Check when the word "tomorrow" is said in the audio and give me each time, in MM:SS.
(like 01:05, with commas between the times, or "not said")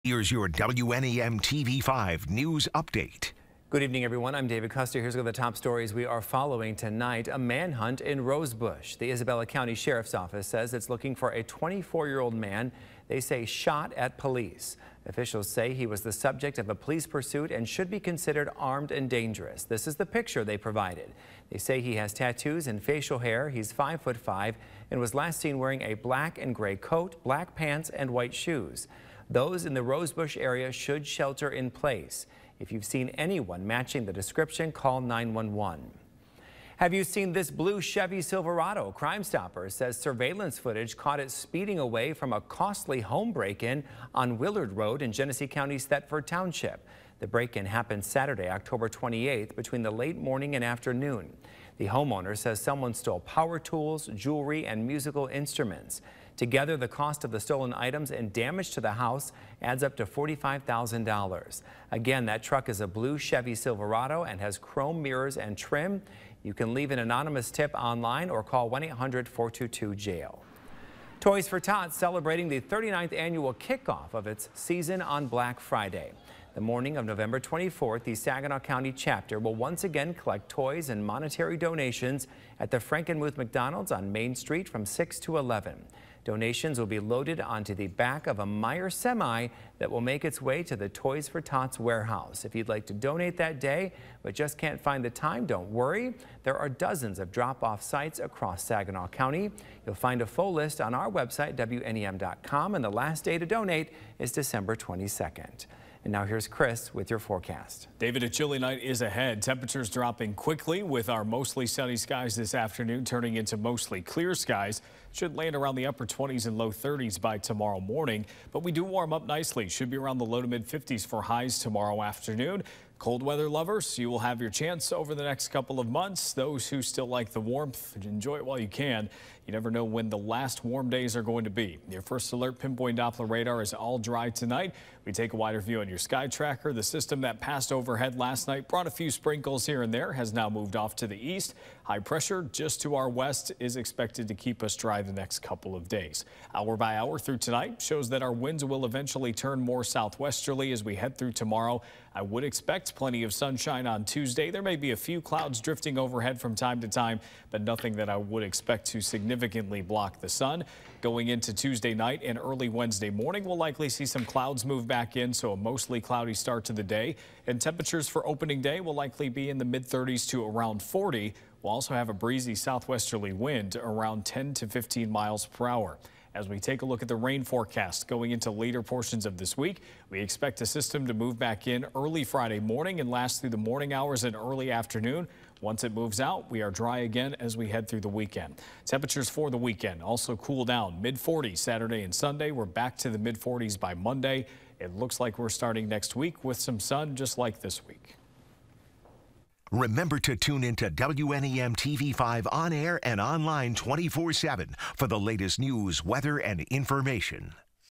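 01:57, 02:01, 02:31.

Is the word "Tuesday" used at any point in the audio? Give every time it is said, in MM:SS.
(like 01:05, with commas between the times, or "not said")
02:34, 02:41.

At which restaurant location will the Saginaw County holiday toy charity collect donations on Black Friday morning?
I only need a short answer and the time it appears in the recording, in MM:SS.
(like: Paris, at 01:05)
Frankenmuth McDonald's, at 01:22.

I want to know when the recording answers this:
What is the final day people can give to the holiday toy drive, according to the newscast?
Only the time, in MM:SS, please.
01:44.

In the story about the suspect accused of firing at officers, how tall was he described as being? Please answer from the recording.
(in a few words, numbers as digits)
5 foot 5.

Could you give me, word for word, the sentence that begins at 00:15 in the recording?
Officials say he was the subject of a police pursuit and should be considered armed and dangerous.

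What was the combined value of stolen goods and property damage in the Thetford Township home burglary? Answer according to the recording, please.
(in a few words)
$45,000.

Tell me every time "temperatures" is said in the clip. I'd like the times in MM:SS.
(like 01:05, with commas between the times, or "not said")
01:49, 02:47, 03:08.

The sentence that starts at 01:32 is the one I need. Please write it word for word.
If you'd like to donate that day but just can't find the time, don't worry.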